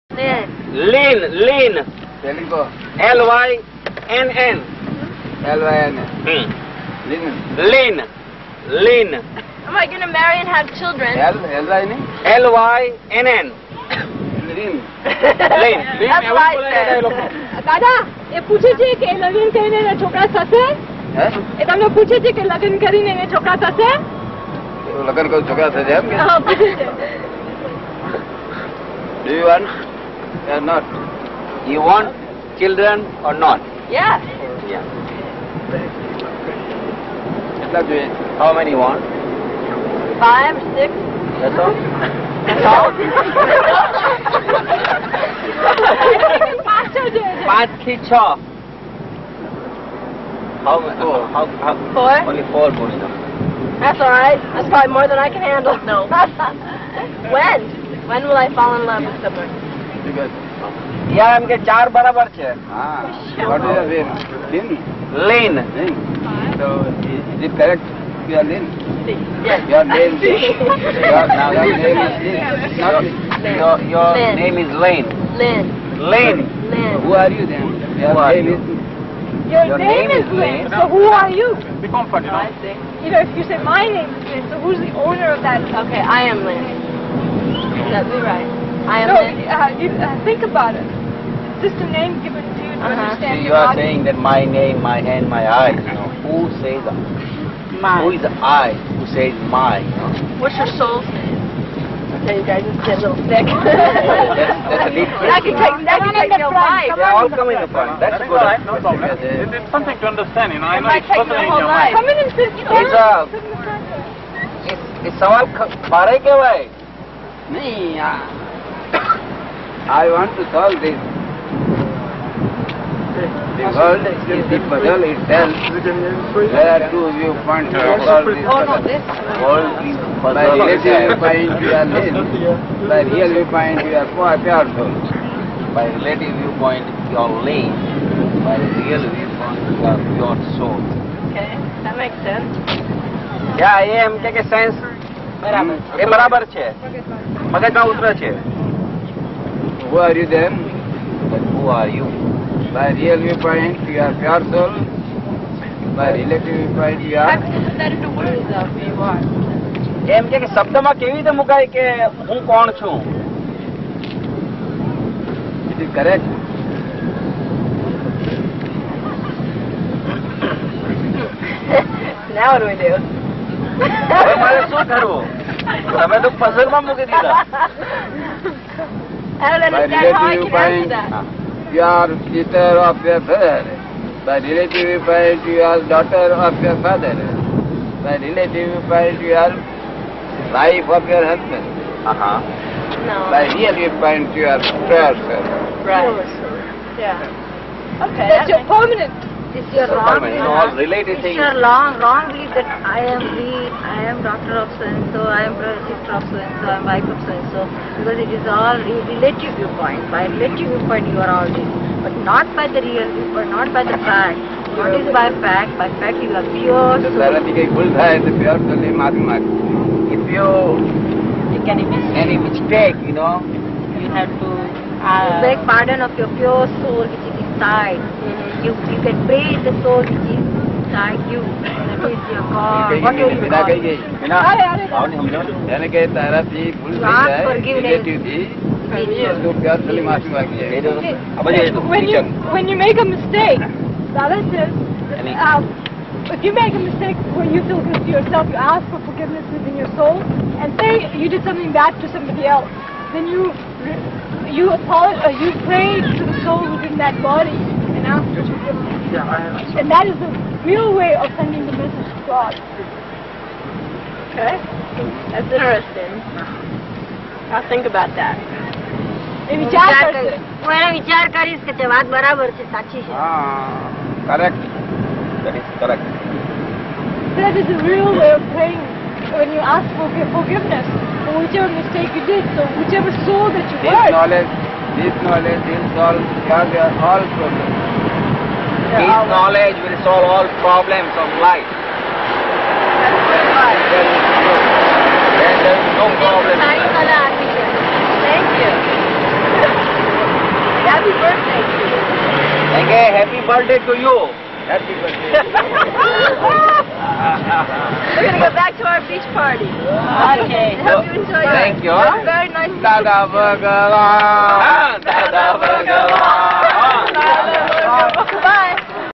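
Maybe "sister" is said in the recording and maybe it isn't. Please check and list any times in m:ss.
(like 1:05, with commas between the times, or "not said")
3:02, 3:25.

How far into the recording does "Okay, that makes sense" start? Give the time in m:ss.
2:21.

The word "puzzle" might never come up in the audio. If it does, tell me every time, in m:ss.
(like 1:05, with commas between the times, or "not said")
2:04, 2:08.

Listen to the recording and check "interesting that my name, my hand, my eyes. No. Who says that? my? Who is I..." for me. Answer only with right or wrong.
wrong.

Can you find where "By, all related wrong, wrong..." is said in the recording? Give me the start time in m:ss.
3:20.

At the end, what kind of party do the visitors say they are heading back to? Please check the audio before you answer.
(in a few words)
beach party.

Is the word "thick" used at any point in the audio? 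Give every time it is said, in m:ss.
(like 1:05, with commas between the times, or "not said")
1:43.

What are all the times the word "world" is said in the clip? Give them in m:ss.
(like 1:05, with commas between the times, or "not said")
2:03, 2:09.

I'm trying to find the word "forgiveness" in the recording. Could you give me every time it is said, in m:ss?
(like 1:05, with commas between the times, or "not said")
4:09, 4:18, 4:40.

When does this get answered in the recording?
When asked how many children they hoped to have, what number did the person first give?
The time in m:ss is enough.
0:40.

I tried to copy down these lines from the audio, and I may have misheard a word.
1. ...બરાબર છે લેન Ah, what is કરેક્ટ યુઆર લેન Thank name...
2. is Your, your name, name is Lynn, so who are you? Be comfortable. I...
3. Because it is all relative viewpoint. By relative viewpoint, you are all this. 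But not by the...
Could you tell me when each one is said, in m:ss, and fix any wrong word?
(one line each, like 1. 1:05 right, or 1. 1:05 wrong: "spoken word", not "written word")
1. 1:01 wrong: "Your", not "Thank"
2. 1:18 right
3. 3:27 right.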